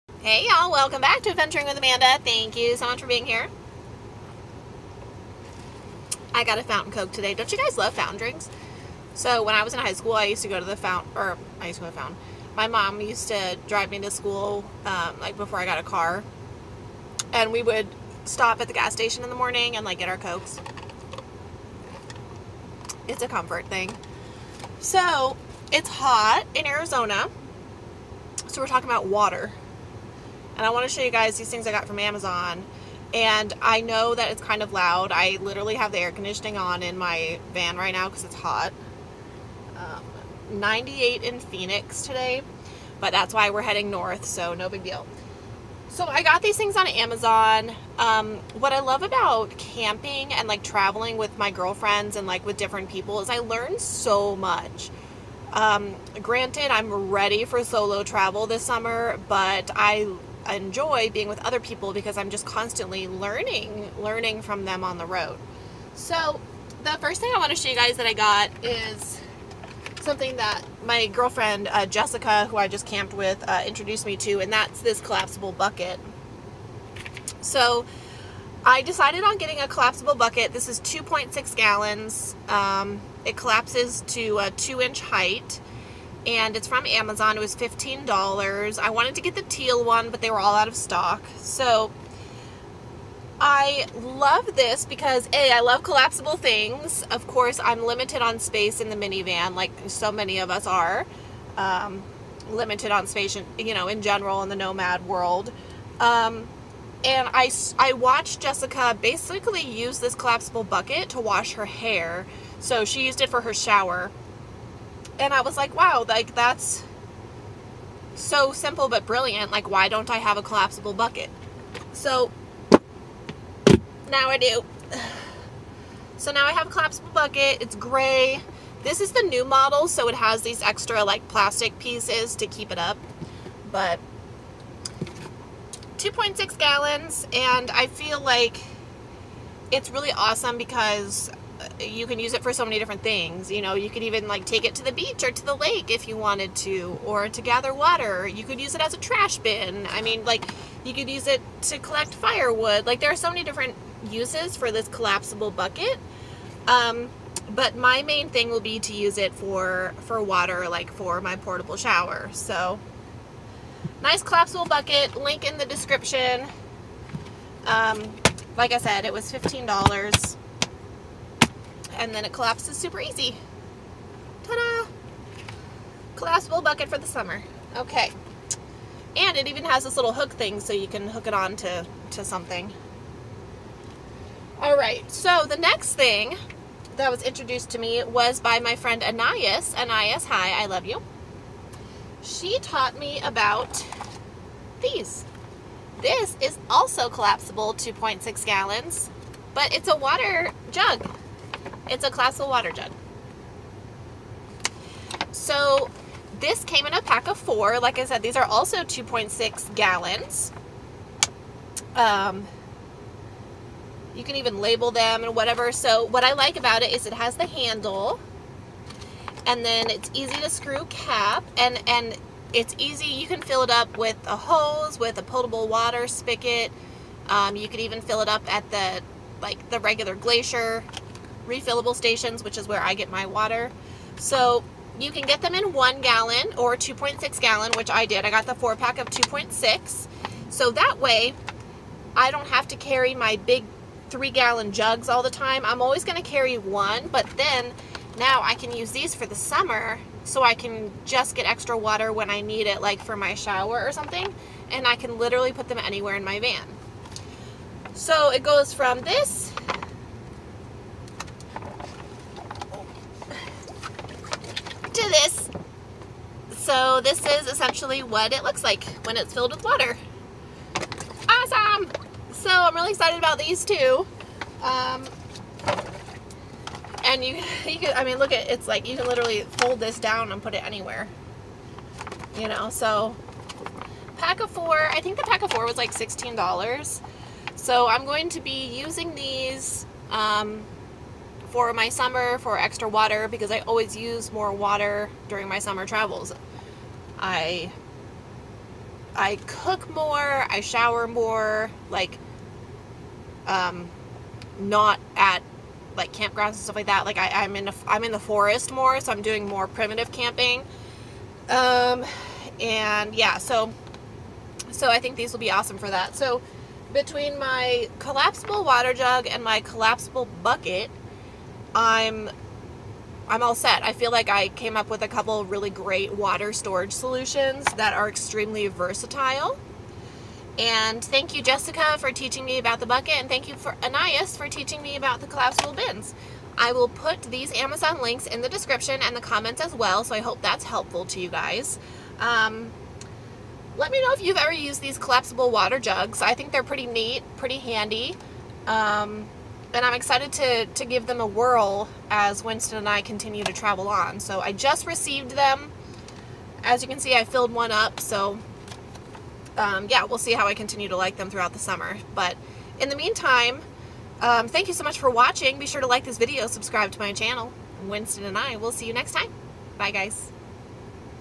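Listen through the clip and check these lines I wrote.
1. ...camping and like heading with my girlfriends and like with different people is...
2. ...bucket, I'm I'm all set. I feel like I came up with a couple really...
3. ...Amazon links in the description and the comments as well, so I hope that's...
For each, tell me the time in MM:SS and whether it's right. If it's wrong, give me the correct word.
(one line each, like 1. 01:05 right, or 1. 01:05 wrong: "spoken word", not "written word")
1. 00:49 wrong: "traveling", not "heading"
2. 05:20 right
3. 05:37 right.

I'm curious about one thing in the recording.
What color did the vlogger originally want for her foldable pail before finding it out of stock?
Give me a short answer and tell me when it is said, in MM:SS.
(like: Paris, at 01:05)
teal, at 01:29.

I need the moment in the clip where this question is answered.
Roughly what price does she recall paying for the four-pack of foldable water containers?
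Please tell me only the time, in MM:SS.
04:45.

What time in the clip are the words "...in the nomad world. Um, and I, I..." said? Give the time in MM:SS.
01:44.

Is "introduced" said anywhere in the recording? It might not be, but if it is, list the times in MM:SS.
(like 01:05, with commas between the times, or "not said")
01:13, 03:07.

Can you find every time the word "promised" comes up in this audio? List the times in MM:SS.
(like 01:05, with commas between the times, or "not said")
not said.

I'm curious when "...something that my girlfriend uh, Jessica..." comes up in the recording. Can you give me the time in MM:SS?
01:10.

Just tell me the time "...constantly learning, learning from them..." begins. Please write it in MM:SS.
01:02.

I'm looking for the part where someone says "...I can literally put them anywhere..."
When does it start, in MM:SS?
04:14.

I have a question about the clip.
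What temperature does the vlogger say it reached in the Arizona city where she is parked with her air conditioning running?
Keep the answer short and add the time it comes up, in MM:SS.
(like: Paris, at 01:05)
98, at 00:40.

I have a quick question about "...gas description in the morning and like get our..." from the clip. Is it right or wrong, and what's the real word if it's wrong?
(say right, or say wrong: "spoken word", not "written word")
wrong: "station", not "description".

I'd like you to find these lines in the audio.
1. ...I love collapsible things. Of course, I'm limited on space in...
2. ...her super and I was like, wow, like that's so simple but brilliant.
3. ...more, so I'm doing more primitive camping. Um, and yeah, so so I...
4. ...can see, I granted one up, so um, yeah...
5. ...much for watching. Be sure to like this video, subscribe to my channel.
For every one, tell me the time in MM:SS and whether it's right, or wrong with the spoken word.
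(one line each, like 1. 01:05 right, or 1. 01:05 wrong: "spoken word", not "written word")
1. 01:35 right
2. 01:53 wrong: "shower", not "super"
3. 05:08 right
4. 05:56 wrong: "filled", not "granted"
5. 06:04 right.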